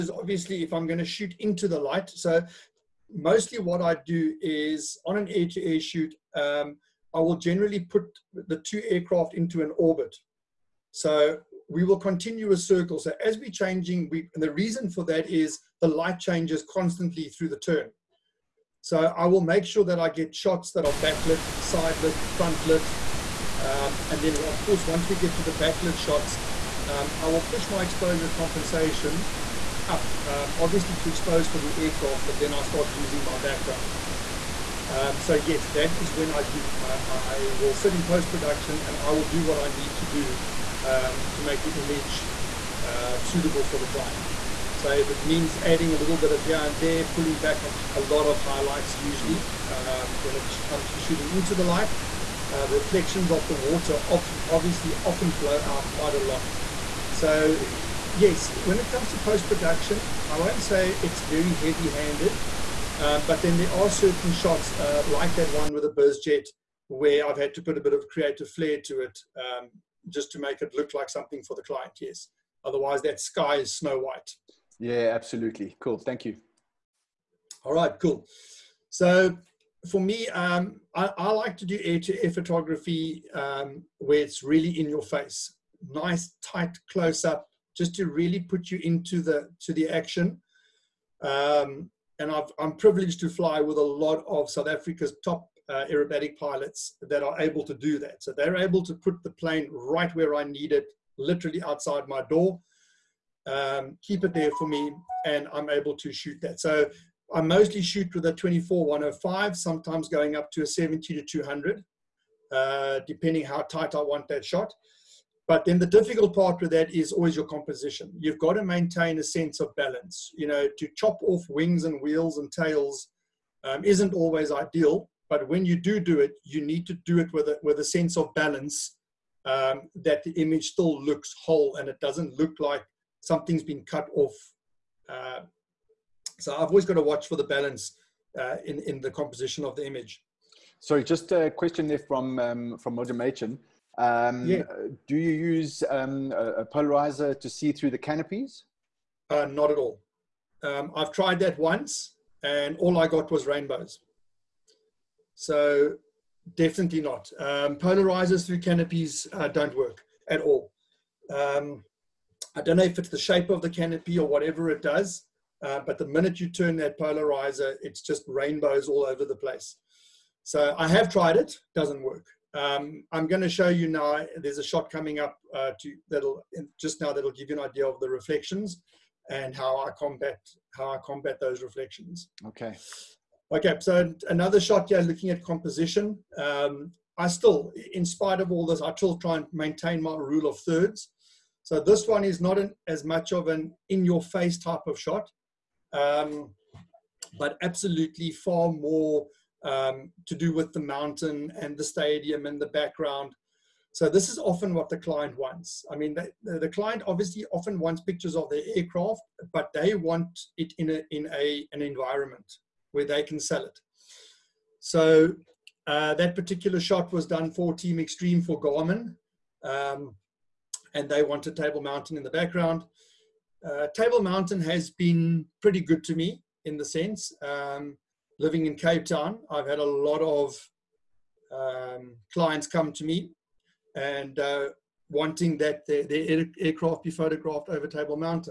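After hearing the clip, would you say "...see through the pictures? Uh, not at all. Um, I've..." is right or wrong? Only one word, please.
wrong.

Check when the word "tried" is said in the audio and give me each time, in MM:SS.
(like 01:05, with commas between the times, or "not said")
02:31, 02:51.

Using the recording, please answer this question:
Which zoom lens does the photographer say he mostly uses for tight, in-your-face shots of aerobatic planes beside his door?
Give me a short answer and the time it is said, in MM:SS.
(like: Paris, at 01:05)
24-105, at 01:48.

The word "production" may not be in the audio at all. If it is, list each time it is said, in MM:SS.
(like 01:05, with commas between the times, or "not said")
00:38, 00:59.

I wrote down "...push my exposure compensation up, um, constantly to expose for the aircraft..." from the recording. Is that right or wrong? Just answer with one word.
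wrong.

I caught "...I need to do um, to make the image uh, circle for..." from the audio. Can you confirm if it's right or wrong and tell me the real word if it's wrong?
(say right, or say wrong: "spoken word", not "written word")
wrong: "suitable", not "circle".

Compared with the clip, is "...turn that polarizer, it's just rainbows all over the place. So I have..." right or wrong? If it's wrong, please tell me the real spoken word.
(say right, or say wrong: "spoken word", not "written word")
right.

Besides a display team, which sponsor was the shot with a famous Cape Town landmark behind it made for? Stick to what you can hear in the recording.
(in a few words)
Garmin.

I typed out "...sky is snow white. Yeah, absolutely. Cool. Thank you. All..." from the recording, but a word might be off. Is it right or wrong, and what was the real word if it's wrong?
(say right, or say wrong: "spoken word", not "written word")
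right.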